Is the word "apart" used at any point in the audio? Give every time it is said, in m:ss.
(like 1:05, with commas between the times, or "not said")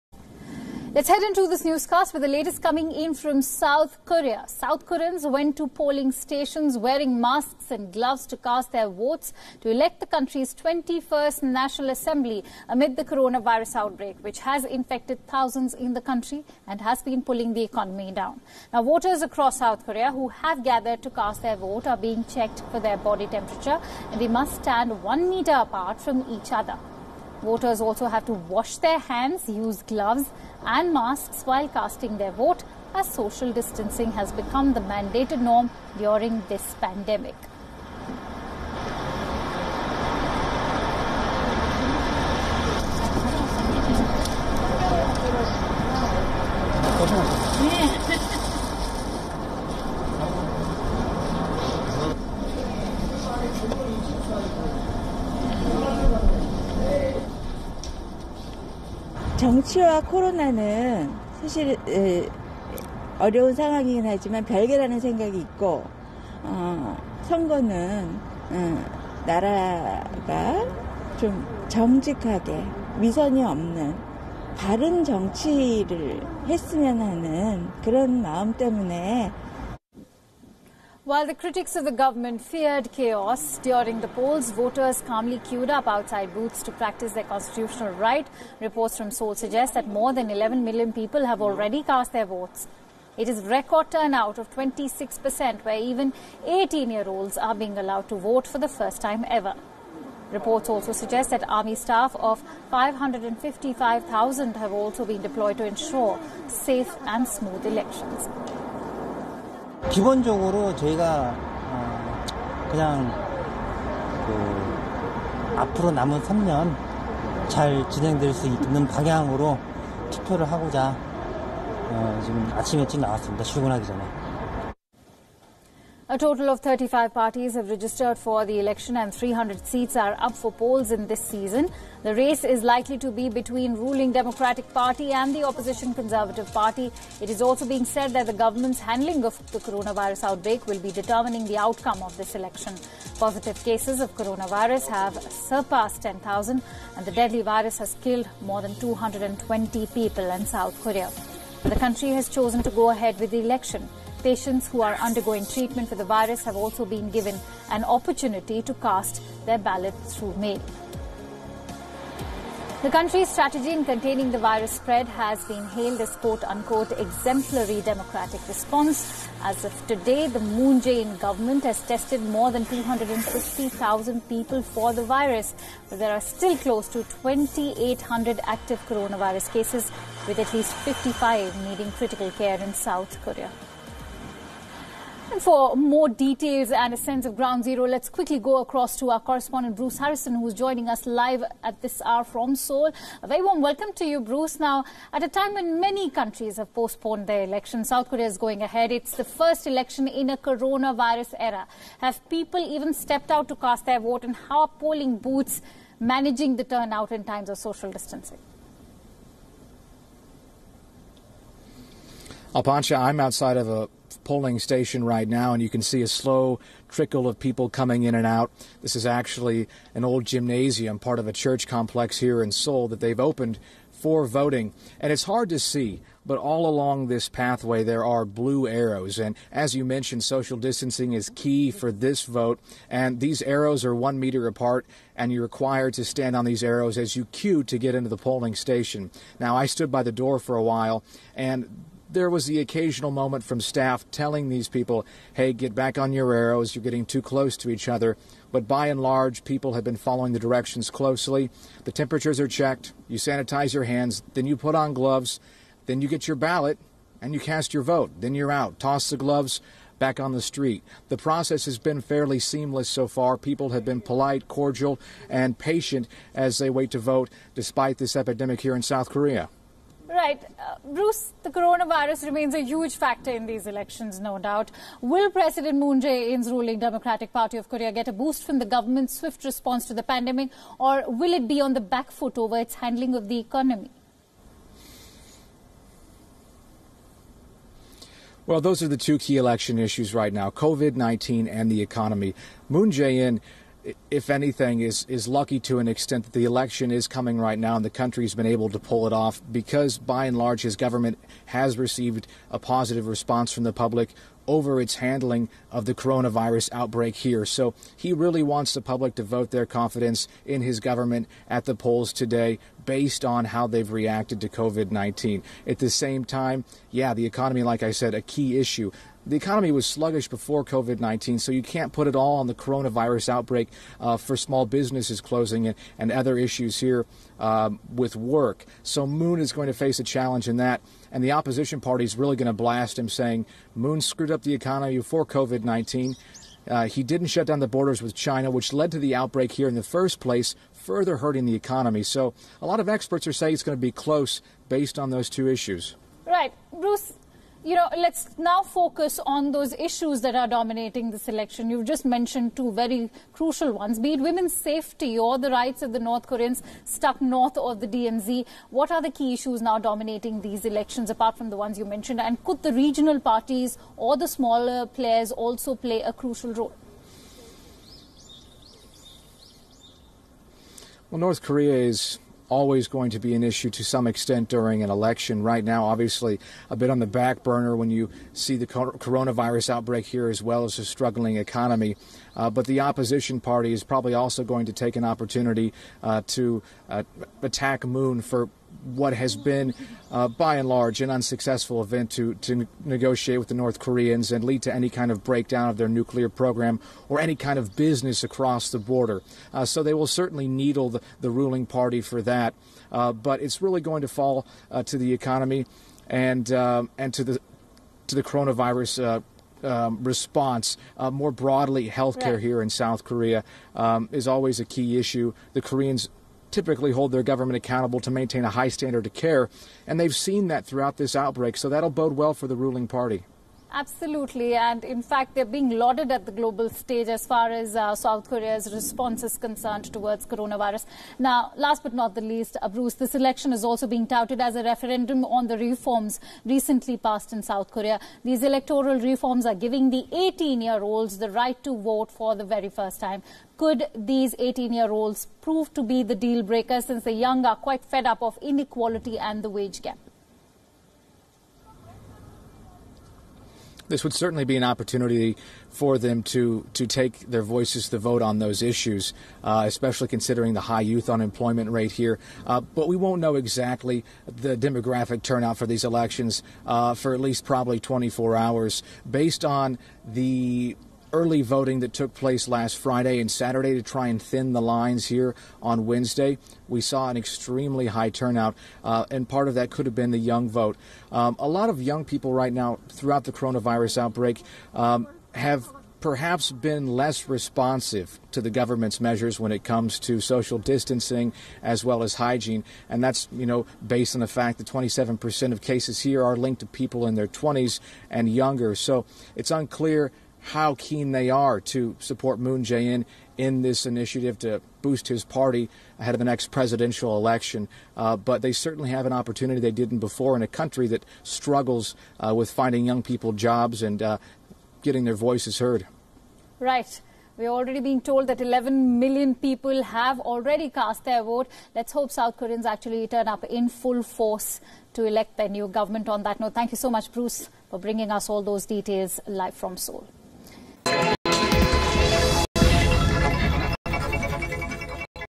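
0:25, 3:54, 6:01.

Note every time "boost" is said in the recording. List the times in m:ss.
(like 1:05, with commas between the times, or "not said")
4:38, 8:24.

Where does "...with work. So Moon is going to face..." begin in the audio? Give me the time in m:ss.
5:27.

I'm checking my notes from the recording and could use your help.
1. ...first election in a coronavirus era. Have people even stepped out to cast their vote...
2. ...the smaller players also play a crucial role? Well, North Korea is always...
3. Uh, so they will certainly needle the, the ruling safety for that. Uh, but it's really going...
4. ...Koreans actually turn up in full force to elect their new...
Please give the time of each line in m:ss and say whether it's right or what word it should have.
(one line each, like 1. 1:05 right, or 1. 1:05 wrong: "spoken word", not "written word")
1. 3:19 right
2. 6:04 right
3. 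6:39 wrong: "party", not "safety"
4. 8:42 right.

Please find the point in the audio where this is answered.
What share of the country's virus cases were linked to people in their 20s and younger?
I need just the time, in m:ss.
8:14.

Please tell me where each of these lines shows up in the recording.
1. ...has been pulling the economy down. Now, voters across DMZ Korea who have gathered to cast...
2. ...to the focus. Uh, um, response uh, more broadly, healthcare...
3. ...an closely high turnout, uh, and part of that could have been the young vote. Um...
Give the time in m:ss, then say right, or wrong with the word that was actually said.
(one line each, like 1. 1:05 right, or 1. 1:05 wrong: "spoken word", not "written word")
1. 0:16 wrong: "South", not "DMZ"
2. 6:48 wrong: "coronavirus", not "focus"
3. 7:57 wrong: "extremely", not "closely".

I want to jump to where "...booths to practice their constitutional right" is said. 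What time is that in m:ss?
1:26.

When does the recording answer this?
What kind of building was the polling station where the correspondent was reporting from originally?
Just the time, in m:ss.
3:40.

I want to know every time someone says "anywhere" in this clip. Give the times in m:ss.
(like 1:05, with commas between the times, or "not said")
not said.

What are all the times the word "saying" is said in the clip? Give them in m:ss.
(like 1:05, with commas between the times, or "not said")
5:33, 5:43.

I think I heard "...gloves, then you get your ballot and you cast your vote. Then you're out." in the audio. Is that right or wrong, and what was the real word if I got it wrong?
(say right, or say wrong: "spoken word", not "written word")
right.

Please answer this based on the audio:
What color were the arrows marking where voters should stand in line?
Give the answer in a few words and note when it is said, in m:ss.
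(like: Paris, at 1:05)
Blue, at 3:48.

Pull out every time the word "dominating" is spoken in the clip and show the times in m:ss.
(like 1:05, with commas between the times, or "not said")
5:50, 5:59.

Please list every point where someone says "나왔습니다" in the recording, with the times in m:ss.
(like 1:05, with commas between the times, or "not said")
2:03.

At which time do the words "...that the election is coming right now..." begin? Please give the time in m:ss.
4:56.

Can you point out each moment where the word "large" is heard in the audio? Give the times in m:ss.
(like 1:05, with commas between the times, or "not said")
4:08, 5:00, 6:30.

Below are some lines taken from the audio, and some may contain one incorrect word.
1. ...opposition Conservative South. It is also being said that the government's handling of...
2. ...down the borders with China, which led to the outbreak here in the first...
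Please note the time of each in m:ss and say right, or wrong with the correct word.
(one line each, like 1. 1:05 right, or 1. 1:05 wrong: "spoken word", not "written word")
1. 2:15 wrong: "Party", not "South"
2. 5:37 right.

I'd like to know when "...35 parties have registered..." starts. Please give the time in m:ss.
2:06.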